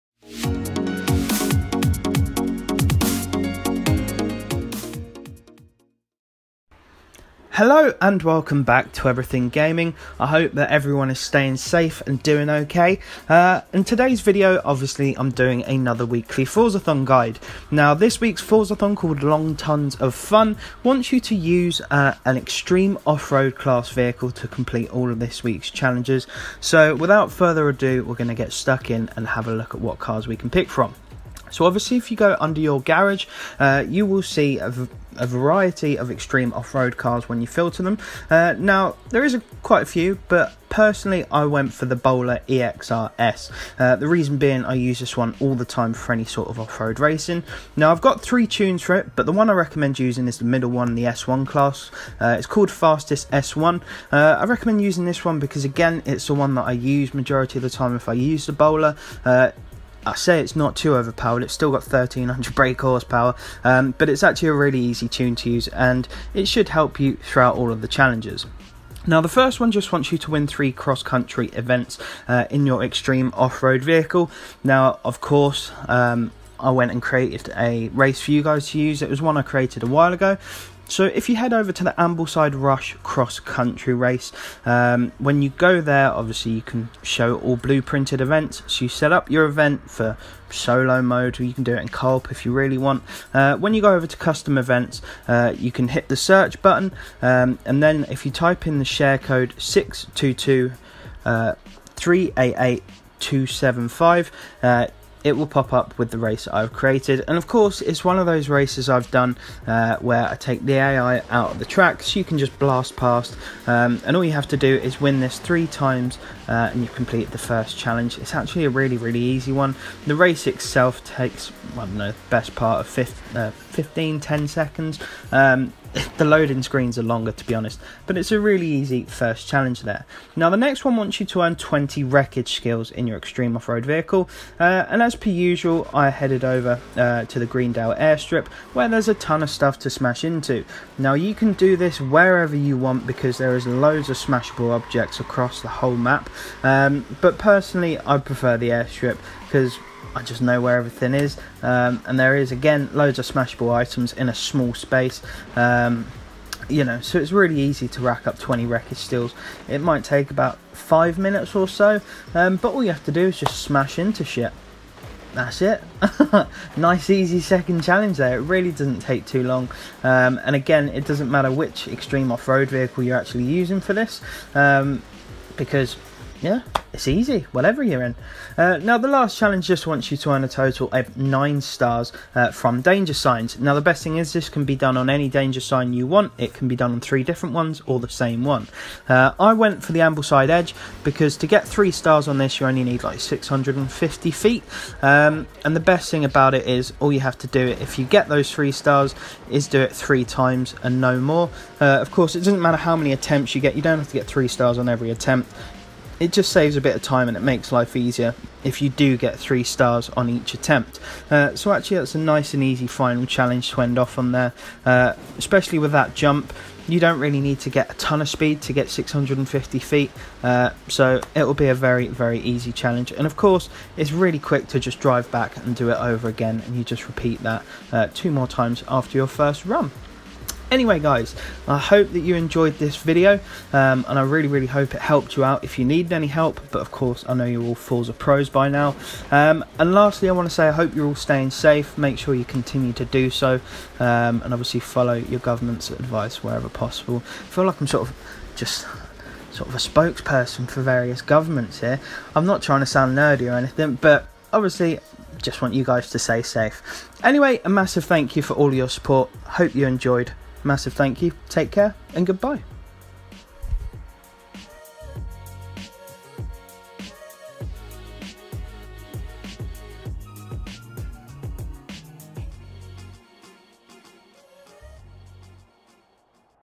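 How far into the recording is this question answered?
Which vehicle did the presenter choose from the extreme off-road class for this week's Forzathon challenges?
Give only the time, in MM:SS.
00:41.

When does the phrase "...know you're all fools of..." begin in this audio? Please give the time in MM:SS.
03:57.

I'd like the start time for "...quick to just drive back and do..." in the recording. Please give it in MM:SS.
03:44.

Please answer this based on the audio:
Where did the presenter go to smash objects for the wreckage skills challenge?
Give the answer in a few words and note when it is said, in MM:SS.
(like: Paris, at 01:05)
Greendale airstrip, at 02:17.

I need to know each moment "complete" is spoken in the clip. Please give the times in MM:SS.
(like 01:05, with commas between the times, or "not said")
00:24, 01:56.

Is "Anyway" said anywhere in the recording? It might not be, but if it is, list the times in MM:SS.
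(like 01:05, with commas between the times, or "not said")
03:50, 04:17.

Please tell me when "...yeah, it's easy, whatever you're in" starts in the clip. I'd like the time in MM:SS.
02:56.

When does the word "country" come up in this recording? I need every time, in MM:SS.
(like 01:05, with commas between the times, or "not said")
01:11, 01:23.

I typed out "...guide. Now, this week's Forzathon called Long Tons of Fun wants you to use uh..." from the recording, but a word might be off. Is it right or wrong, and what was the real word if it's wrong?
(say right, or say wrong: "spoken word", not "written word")
right.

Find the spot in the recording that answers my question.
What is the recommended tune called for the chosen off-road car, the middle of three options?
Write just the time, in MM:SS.
00:52.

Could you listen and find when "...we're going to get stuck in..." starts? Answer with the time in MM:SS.
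00:28.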